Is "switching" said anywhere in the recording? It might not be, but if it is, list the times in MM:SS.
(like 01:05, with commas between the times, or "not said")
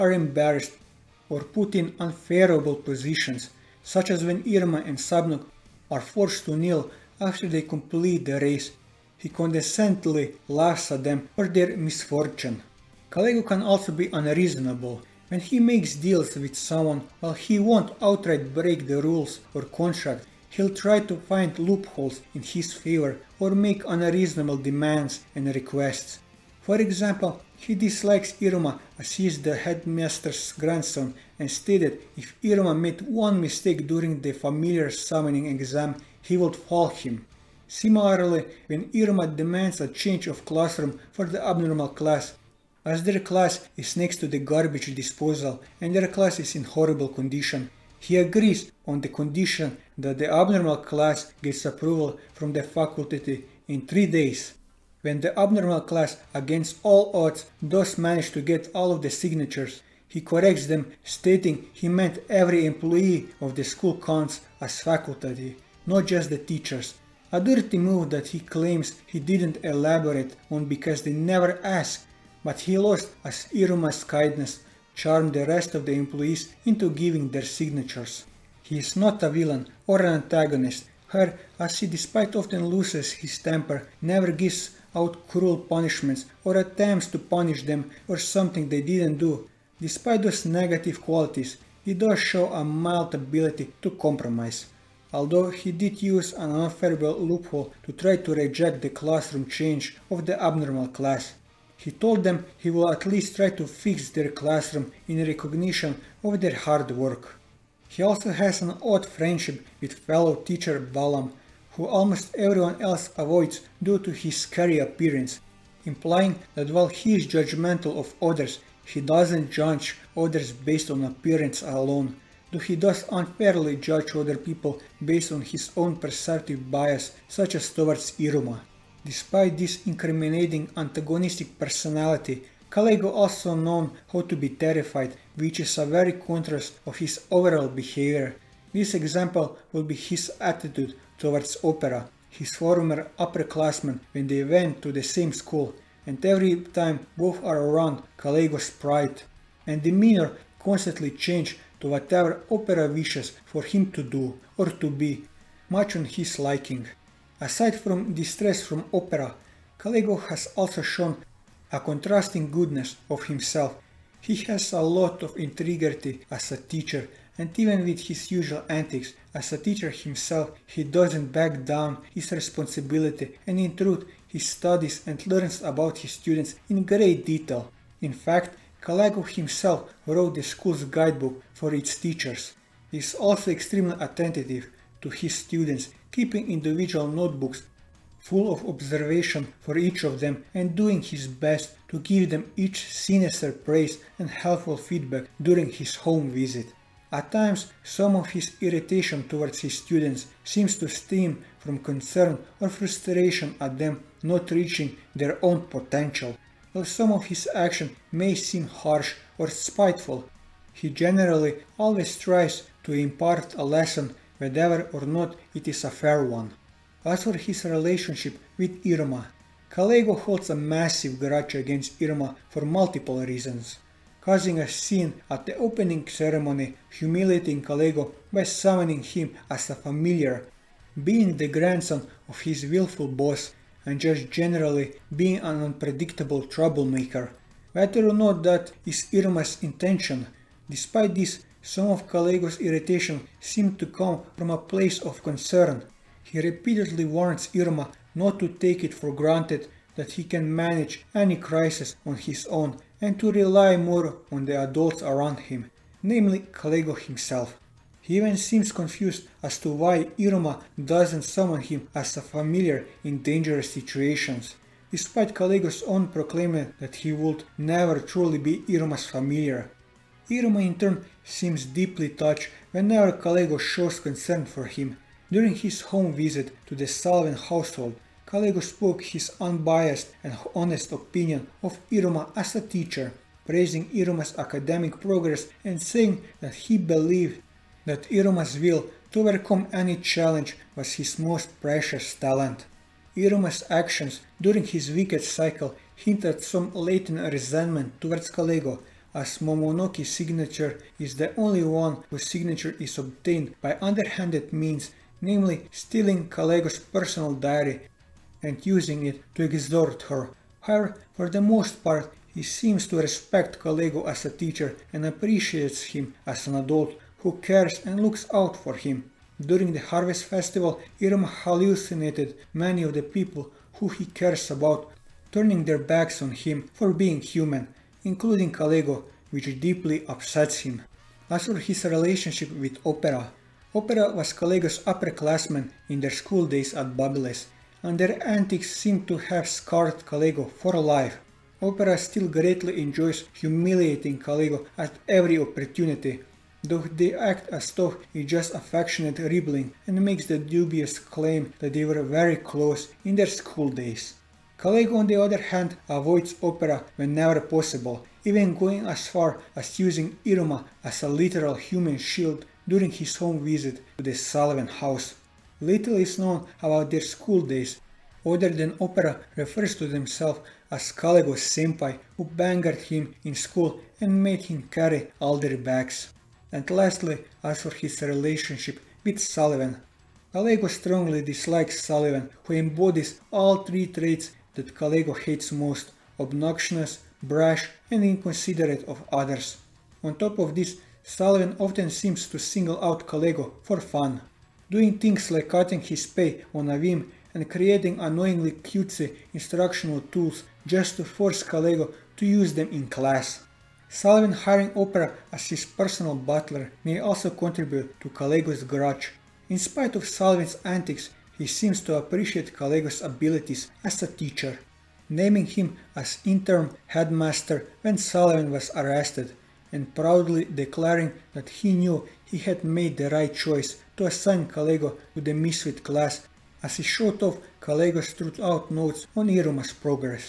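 not said.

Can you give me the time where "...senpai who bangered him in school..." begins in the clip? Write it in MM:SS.
06:11.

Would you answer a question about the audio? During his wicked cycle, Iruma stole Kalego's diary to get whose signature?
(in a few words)
Momonoki.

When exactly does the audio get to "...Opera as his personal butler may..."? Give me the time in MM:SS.
06:44.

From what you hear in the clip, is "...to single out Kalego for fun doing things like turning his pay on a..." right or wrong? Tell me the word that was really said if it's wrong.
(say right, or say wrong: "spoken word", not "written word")
wrong: "cutting", not "turning".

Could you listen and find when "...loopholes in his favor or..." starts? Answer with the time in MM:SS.
00:21.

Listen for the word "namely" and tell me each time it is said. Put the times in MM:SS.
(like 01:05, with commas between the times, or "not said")
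04:16, 05:05.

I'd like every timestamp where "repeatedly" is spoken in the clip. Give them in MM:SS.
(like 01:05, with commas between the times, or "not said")
04:06.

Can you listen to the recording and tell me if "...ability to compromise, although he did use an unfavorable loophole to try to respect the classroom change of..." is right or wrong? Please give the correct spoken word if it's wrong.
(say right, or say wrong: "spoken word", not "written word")
wrong: "reject", not "respect".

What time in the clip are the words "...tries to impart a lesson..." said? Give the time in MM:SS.
03:32.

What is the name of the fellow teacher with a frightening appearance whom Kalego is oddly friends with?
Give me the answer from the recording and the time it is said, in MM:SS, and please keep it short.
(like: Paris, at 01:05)
Balam, at 01:50.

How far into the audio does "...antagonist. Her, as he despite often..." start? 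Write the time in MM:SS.
01:20.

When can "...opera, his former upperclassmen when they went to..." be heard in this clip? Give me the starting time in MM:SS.
02:21.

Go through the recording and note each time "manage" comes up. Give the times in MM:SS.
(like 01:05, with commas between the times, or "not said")
00:57, 04:10.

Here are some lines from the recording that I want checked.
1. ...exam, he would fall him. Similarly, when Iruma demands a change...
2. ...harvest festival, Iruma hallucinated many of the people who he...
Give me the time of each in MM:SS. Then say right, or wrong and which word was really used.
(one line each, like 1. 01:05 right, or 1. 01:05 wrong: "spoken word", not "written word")
1. 00:35 right
2. 05:19 right.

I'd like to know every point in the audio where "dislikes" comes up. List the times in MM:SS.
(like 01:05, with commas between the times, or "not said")
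00:27, 06:21.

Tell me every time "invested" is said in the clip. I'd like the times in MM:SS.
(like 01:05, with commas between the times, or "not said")
not said.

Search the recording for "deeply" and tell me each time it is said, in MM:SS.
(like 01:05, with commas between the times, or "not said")
04:31, 05:29.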